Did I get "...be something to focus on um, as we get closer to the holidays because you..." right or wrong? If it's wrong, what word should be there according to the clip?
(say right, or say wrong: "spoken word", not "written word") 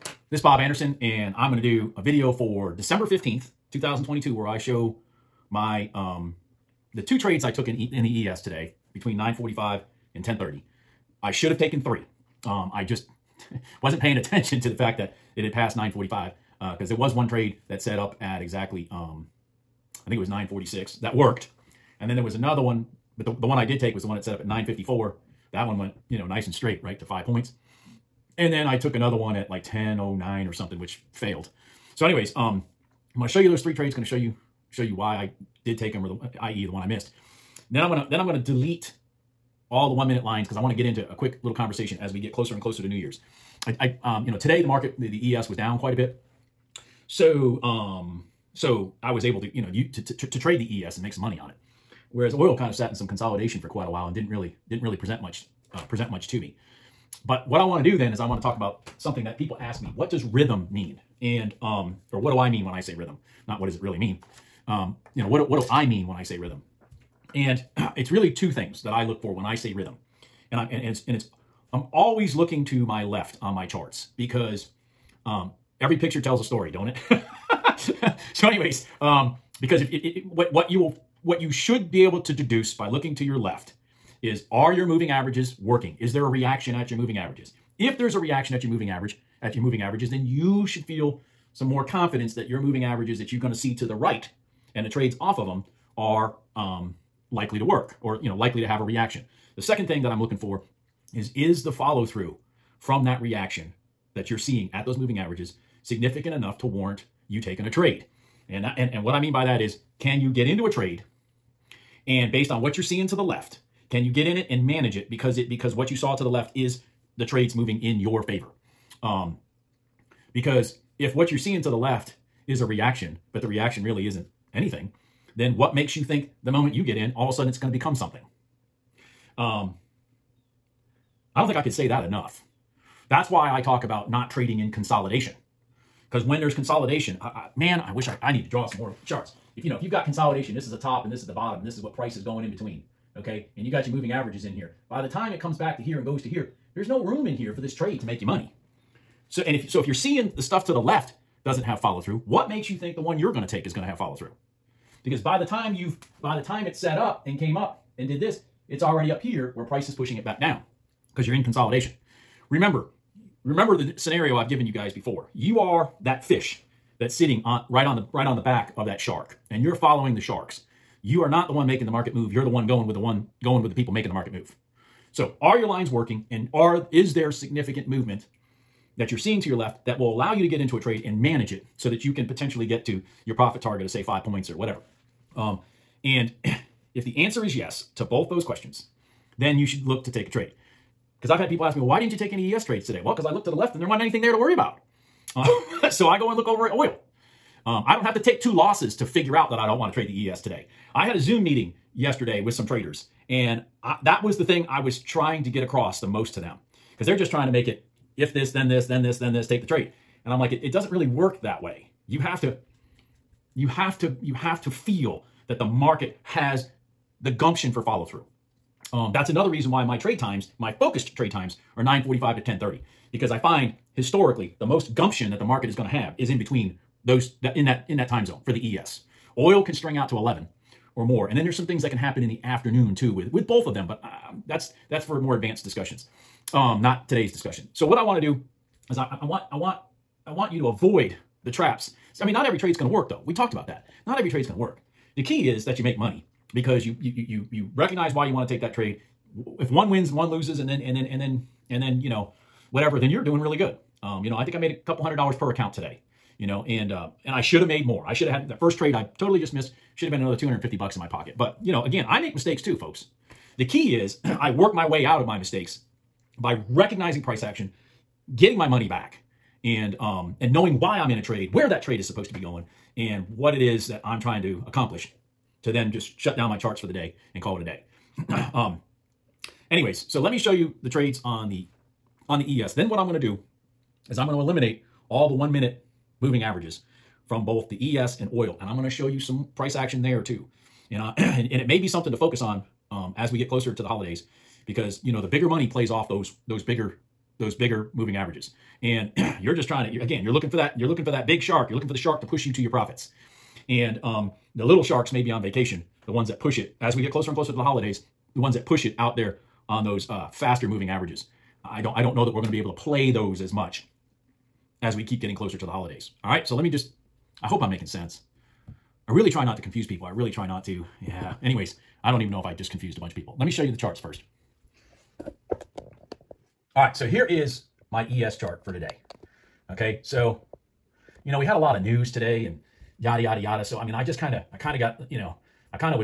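right.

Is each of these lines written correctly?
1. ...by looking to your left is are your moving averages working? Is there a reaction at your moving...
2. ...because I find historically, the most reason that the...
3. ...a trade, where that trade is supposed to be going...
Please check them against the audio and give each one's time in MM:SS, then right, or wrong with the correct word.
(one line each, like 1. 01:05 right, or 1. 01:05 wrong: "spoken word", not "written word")
1. 01:22 right
2. 03:43 wrong: "gumption", not "reason"
3. 04:31 right.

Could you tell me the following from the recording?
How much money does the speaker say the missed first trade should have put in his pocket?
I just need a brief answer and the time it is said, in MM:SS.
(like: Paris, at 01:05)
$250, at 04:20.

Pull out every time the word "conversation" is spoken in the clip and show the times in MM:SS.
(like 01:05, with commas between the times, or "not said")
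00:41.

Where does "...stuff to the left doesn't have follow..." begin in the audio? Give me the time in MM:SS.
02:30.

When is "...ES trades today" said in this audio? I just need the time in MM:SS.
03:12.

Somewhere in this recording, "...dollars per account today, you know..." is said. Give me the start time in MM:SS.
04:15.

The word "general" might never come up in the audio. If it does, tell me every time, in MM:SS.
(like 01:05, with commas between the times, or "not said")
not said.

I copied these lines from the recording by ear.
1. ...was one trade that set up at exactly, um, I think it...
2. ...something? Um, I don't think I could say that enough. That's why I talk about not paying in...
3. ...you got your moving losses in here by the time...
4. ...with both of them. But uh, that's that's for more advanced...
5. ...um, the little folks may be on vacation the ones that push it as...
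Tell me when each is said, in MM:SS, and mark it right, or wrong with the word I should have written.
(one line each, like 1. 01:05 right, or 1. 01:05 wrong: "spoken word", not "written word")
1. 00:16 right
2. 02:07 wrong: "trading", not "paying"
3. 02:23 wrong: "averages", not "losses"
4. 03:53 right
5. 05:04 wrong: "sharks", not "folks".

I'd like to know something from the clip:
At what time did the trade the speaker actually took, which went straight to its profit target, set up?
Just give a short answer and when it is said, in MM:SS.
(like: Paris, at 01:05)
9:54, at 00:24.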